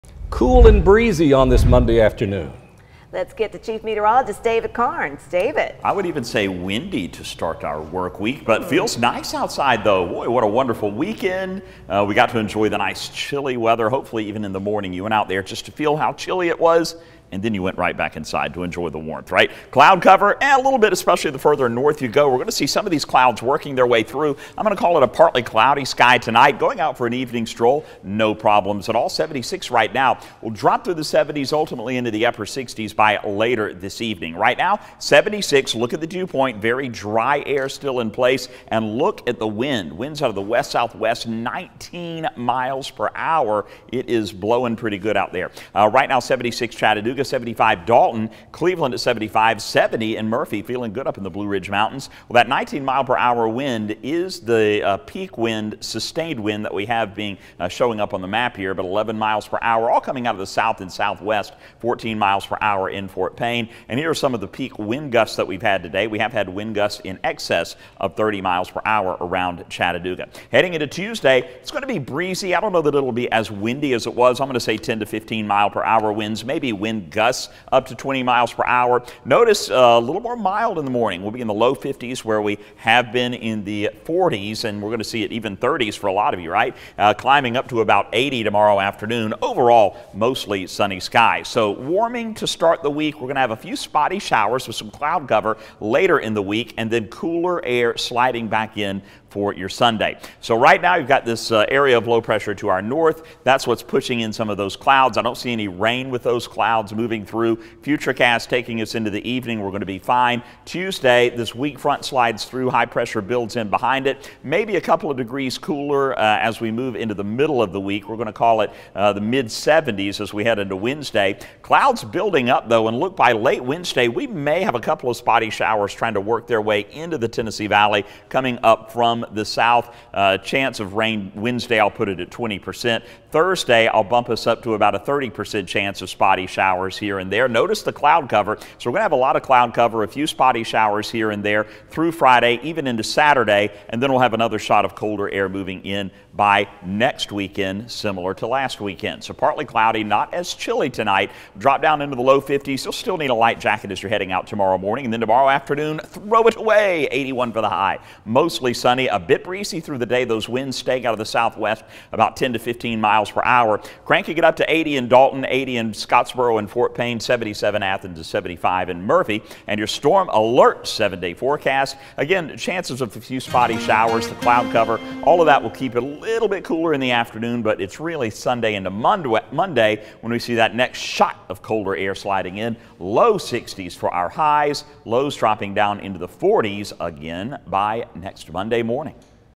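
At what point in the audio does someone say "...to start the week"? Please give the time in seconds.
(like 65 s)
92 s.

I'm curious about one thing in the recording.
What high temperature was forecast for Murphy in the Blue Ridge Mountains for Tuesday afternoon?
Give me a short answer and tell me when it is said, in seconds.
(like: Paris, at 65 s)
75, at 168 s.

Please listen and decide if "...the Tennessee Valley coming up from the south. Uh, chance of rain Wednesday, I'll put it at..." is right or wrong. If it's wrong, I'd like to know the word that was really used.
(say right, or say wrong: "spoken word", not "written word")
right.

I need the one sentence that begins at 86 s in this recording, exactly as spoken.
Uh, climbing up to about 80 tomorrow afternoon.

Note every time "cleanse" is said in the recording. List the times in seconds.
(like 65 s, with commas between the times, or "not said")
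not said.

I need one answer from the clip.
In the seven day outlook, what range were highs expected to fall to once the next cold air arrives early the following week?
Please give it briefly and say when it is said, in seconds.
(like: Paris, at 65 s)
Low 60s, at 182 s.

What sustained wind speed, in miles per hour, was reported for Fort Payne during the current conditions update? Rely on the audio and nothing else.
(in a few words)
14 mph.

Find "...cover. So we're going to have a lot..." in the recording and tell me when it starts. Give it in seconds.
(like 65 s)
138 s.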